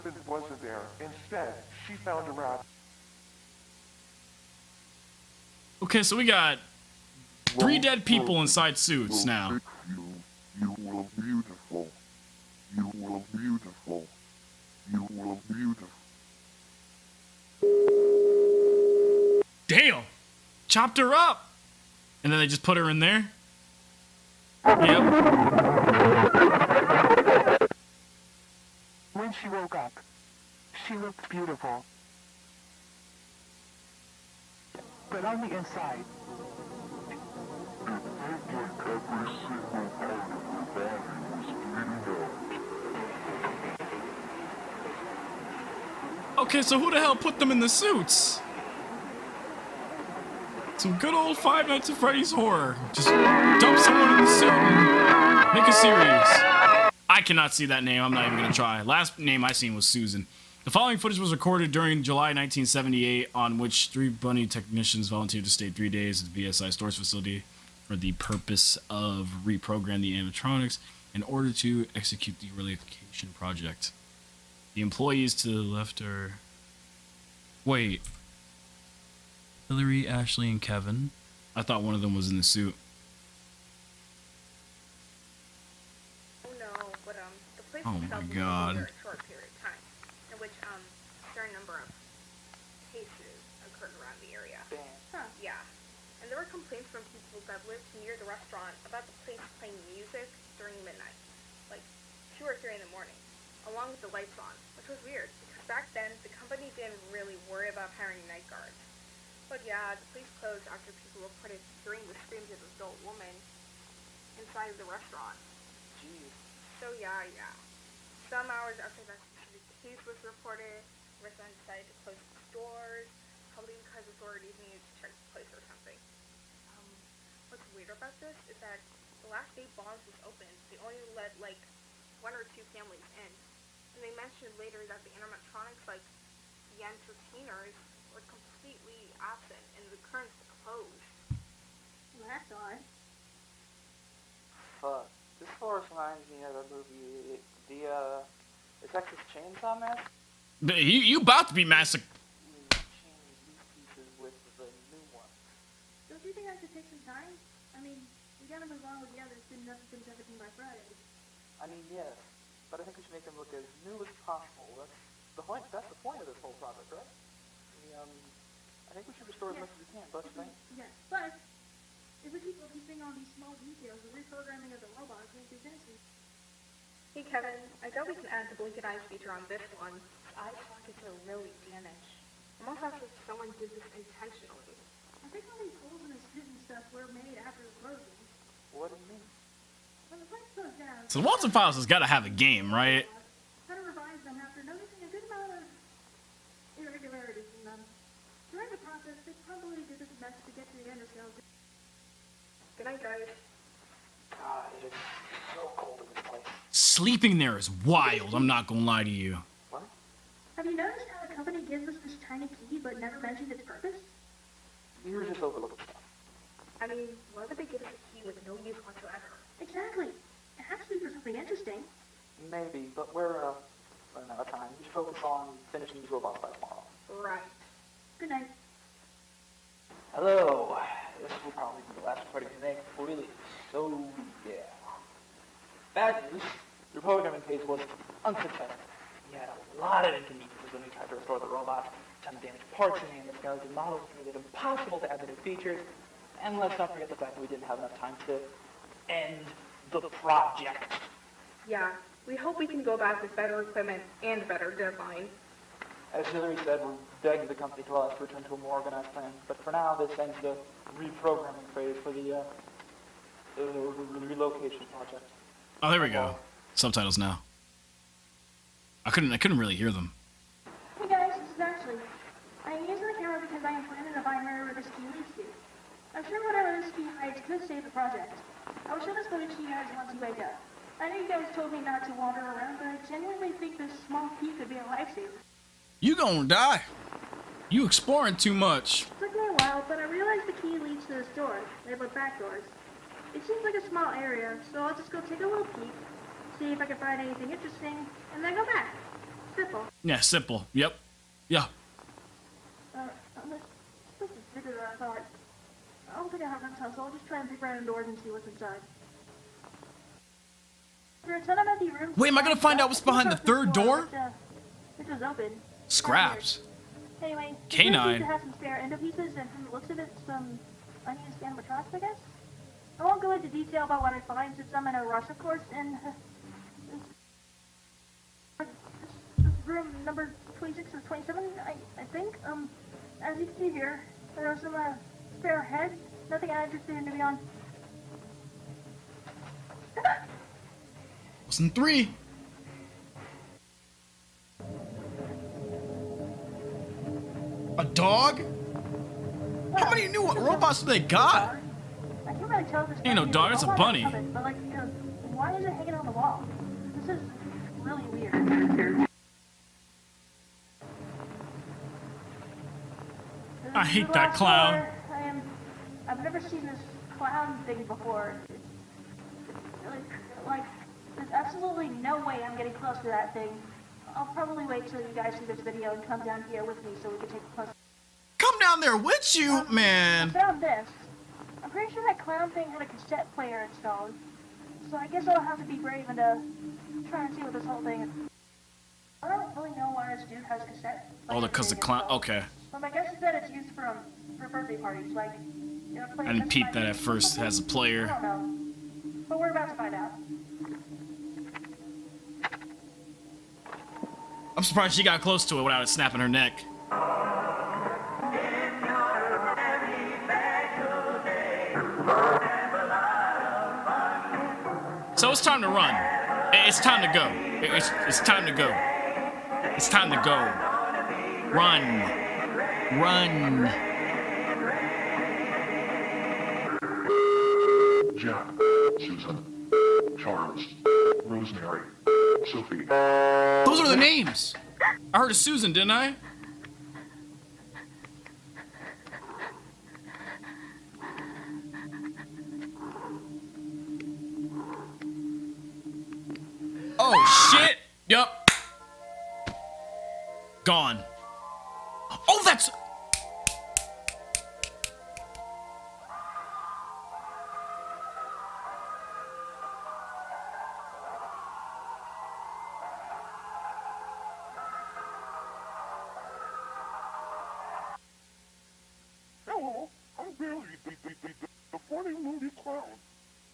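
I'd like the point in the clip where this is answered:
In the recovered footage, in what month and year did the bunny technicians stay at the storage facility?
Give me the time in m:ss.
1:02.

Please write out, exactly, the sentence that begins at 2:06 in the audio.
Um, what's weird about this is that the last day Bon's was open, they only let like one or two families in.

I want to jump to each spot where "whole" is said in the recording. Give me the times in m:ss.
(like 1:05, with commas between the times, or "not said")
2:46, 6:27.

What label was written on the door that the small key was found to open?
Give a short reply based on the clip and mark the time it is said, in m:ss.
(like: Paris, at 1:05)
Back doors, at 4:52.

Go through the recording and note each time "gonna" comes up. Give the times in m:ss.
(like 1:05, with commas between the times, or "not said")
3:28, 4:46, 5:12.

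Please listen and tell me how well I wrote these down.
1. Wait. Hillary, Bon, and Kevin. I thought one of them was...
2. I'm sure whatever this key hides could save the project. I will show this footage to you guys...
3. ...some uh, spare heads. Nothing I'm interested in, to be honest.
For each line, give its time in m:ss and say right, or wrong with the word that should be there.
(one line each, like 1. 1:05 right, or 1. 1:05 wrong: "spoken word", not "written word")
1. 1:17 wrong: "Ashley", not "Bon"
2. 4:36 right
3. 5:34 right.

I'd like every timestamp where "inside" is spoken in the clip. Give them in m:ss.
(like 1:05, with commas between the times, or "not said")
0:08, 0:35, 1:54, 5:08.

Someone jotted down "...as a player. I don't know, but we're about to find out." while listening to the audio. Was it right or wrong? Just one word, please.
right.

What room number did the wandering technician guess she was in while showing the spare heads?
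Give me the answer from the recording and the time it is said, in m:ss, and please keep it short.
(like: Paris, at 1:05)
26 or 27, at 5:30.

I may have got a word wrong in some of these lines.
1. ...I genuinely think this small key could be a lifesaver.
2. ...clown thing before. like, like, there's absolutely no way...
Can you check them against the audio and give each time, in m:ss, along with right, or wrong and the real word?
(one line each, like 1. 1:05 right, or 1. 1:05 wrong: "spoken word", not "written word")
1. 4:42 right
2. 6:07 right.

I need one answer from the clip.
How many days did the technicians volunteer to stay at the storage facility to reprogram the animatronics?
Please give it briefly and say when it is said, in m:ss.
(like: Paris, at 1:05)
3, at 1:05.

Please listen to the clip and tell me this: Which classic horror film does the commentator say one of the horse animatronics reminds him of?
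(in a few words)
The Texas Chainsaw Massacre.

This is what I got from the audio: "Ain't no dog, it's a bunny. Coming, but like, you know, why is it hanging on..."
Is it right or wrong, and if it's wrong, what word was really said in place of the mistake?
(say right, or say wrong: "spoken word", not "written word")
right.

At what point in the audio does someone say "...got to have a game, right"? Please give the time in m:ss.
3:11.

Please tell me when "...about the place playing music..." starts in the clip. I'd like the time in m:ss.
1:38.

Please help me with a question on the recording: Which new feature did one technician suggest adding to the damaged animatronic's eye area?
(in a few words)
Blinking eyes.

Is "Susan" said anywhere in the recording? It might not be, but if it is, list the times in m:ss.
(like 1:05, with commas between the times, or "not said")
0:59, 7:08, 7:15.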